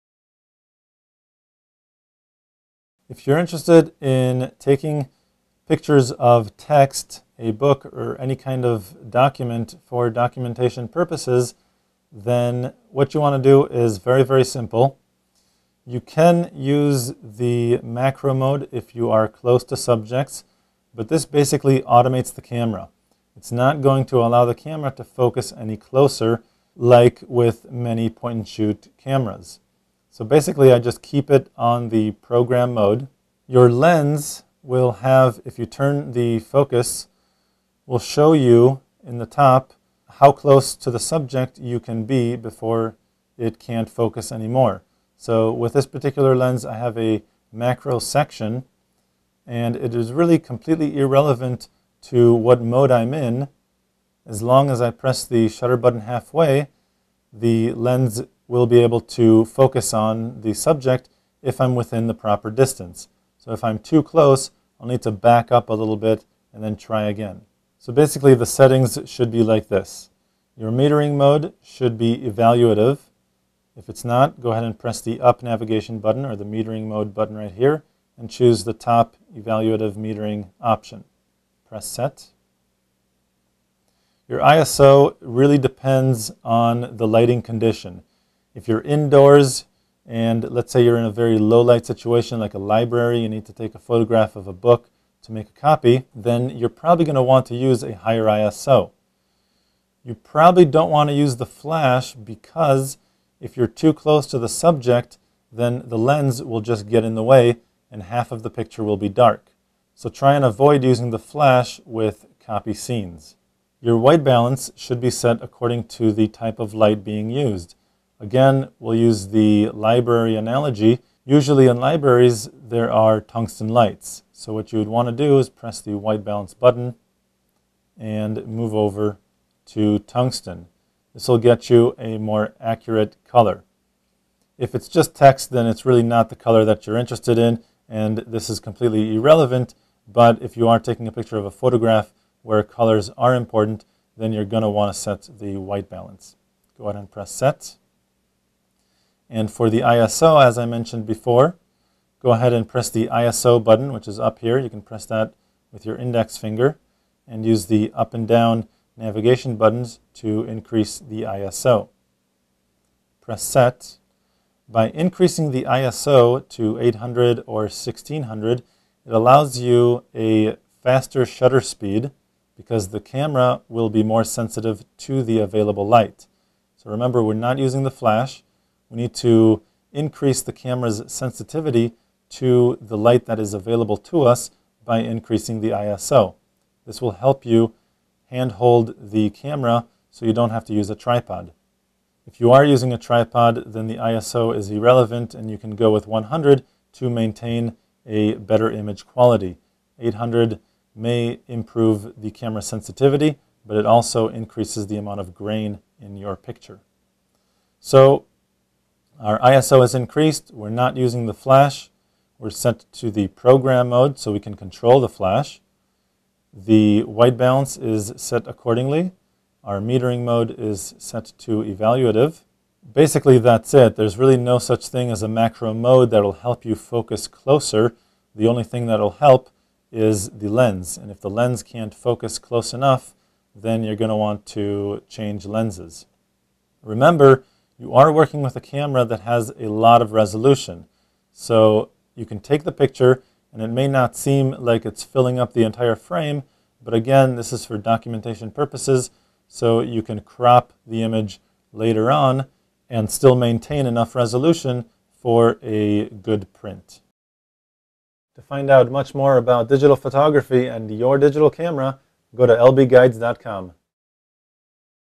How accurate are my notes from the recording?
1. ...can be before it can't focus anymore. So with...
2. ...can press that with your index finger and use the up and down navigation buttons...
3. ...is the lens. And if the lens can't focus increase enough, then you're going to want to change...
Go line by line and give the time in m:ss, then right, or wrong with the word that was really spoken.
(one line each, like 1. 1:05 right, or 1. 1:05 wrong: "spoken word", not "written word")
1. 0:41 right
2. 2:34 right
3. 3:49 wrong: "close", not "increase".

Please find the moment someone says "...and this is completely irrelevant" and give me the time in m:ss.
2:17.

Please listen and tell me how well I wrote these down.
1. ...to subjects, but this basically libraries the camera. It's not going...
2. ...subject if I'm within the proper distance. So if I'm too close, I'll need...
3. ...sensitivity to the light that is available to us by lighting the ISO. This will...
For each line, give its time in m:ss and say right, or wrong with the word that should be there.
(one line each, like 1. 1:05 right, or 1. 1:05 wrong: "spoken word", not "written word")
1. 0:19 wrong: "automates", not "libraries"
2. 1:00 right
3. 3:01 wrong: "increasing", not "lighting".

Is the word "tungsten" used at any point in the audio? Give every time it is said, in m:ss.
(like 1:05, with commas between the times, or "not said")
2:03, 2:09.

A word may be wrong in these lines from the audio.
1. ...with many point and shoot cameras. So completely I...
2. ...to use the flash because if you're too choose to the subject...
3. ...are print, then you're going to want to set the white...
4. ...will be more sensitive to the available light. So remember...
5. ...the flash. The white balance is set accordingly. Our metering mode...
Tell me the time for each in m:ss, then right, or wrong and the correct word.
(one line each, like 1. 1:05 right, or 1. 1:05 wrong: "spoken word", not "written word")
1. 0:27 wrong: "basically", not "completely"
2. 1:41 wrong: "close", not "choose"
3. 2:23 wrong: "important", not "print"
4. 2:53 right
5. 3:34 right.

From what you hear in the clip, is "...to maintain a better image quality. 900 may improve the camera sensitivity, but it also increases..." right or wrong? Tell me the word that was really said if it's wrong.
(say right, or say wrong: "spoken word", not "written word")
wrong: "800", not "900".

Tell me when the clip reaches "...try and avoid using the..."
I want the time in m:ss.
1:50.